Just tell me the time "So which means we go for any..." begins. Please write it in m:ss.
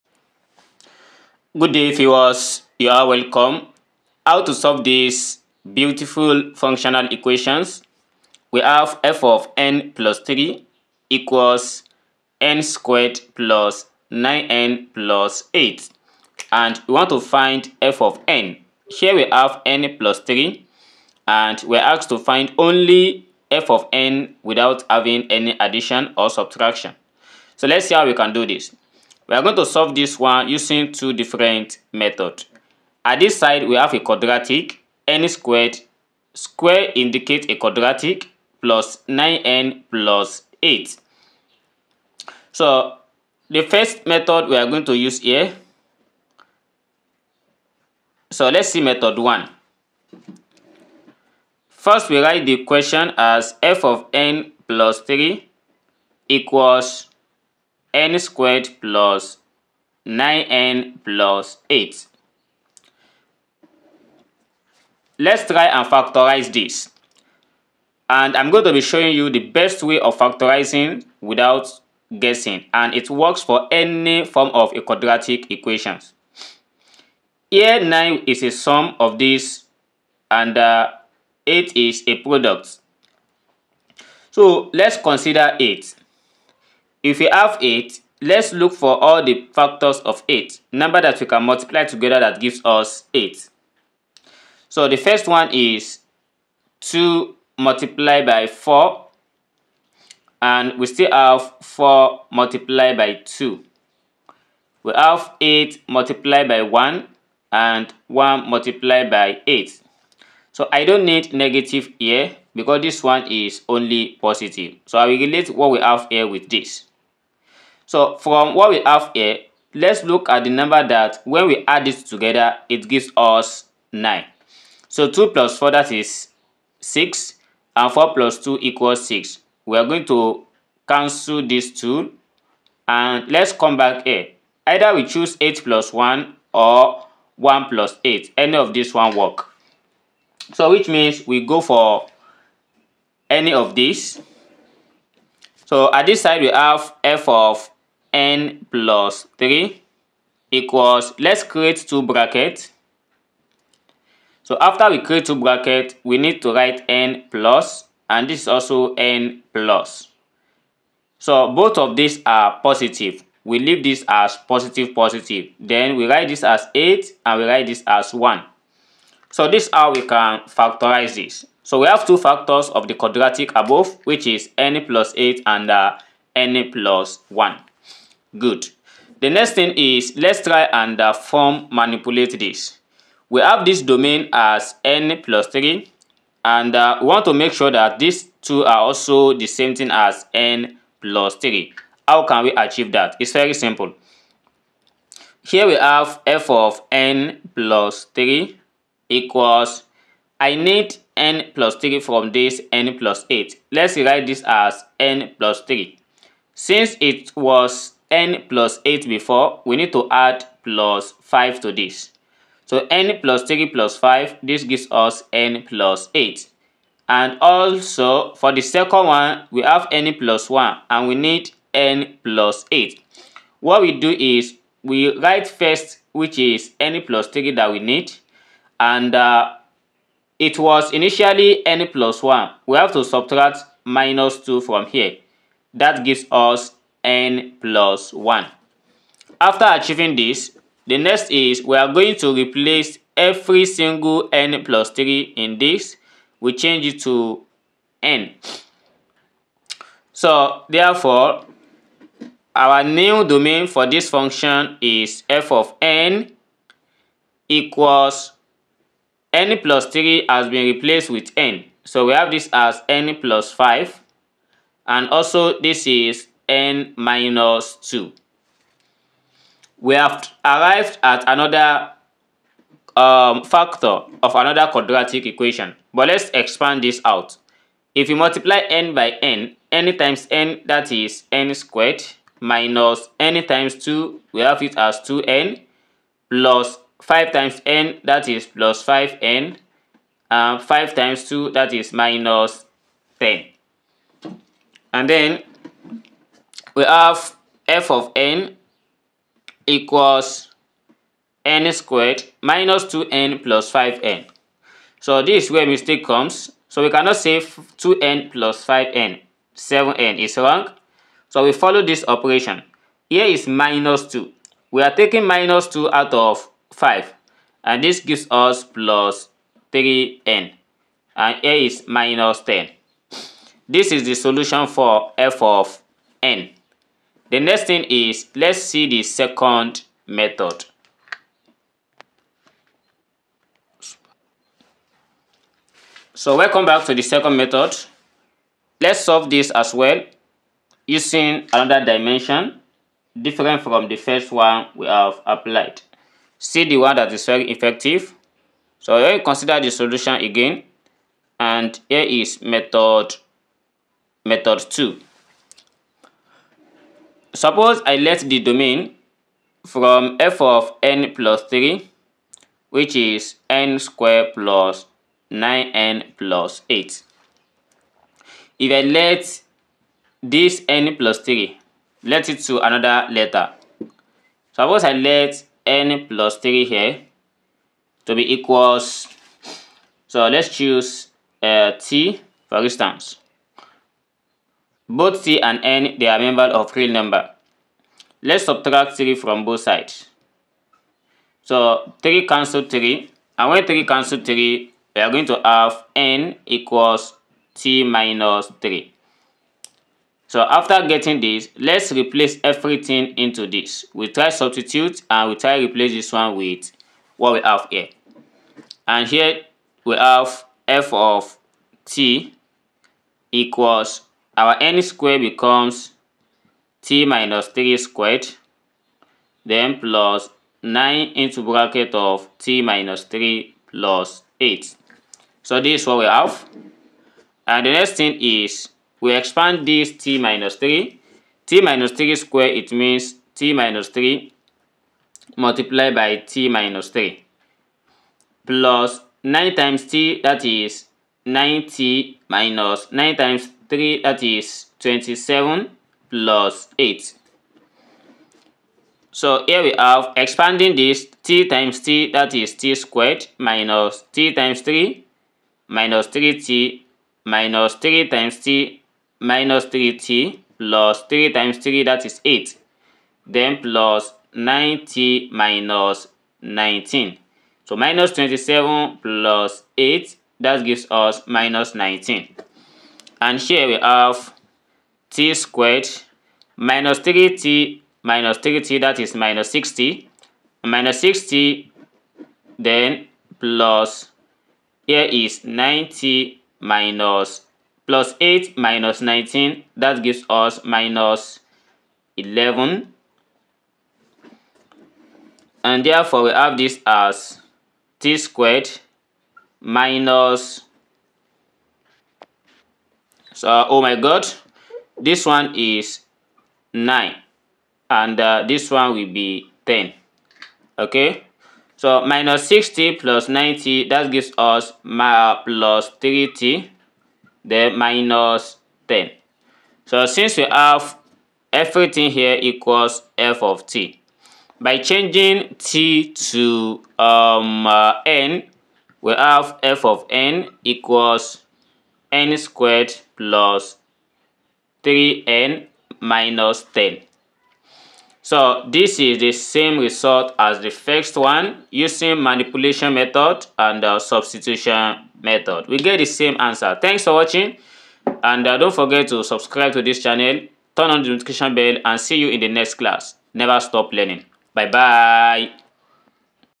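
2:20.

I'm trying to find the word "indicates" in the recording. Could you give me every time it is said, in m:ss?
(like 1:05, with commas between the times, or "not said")
0:36.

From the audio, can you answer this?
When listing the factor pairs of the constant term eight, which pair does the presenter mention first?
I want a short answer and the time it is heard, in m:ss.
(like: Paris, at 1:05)
2 multiplied by 4, at 1:36.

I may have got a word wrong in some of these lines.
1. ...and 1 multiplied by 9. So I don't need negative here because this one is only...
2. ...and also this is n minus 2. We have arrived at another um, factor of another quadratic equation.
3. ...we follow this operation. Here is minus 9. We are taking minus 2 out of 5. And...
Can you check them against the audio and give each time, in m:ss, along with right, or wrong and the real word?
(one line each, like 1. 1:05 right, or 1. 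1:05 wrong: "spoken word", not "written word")
1. 1:47 wrong: "8", not "9"
2. 4:24 right
3. 5:11 wrong: "2", not "9".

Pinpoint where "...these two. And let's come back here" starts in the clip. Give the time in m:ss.
2:11.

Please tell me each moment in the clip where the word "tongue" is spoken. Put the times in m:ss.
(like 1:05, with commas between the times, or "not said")
not said.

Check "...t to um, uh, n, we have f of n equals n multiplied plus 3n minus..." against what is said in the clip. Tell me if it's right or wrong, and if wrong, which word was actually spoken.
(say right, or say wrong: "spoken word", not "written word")
wrong: "squared", not "multiplied".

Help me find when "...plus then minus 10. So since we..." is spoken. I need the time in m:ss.
8:35.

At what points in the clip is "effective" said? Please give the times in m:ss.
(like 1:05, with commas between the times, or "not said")
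5:47.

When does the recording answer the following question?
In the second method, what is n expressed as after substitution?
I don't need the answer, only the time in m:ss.
6:35.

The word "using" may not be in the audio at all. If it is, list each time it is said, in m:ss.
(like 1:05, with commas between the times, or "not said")
0:30, 5:40, 9:01.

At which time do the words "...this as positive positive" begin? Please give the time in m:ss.
2:43.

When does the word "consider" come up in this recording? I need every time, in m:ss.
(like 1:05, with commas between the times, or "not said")
1:24, 5:49.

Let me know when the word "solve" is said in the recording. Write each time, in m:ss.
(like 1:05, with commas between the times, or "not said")
0:04, 0:29, 5:39.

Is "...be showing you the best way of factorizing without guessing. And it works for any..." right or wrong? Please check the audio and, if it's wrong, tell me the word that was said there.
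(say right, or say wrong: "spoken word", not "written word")
right.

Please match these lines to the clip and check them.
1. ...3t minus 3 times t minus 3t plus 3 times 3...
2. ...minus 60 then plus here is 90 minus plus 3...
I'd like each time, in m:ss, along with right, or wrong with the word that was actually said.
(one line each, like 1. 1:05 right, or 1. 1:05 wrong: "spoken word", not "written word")
1. 7:36 right
2. 8:00 wrong: "8", not "3".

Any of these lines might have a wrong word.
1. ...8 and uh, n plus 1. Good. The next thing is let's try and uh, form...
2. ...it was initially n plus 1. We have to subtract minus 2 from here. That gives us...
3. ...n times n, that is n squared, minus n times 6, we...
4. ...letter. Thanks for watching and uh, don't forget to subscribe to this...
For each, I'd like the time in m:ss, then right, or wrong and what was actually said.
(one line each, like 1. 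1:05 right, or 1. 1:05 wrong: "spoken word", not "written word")
1. 2:55 right
2. 3:50 right
3. 4:39 wrong: "2", not "6"
4. 9:06 wrong: "answer", not "letter".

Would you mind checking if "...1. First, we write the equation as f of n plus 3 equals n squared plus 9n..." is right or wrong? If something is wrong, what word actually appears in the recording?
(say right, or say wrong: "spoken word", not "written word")
right.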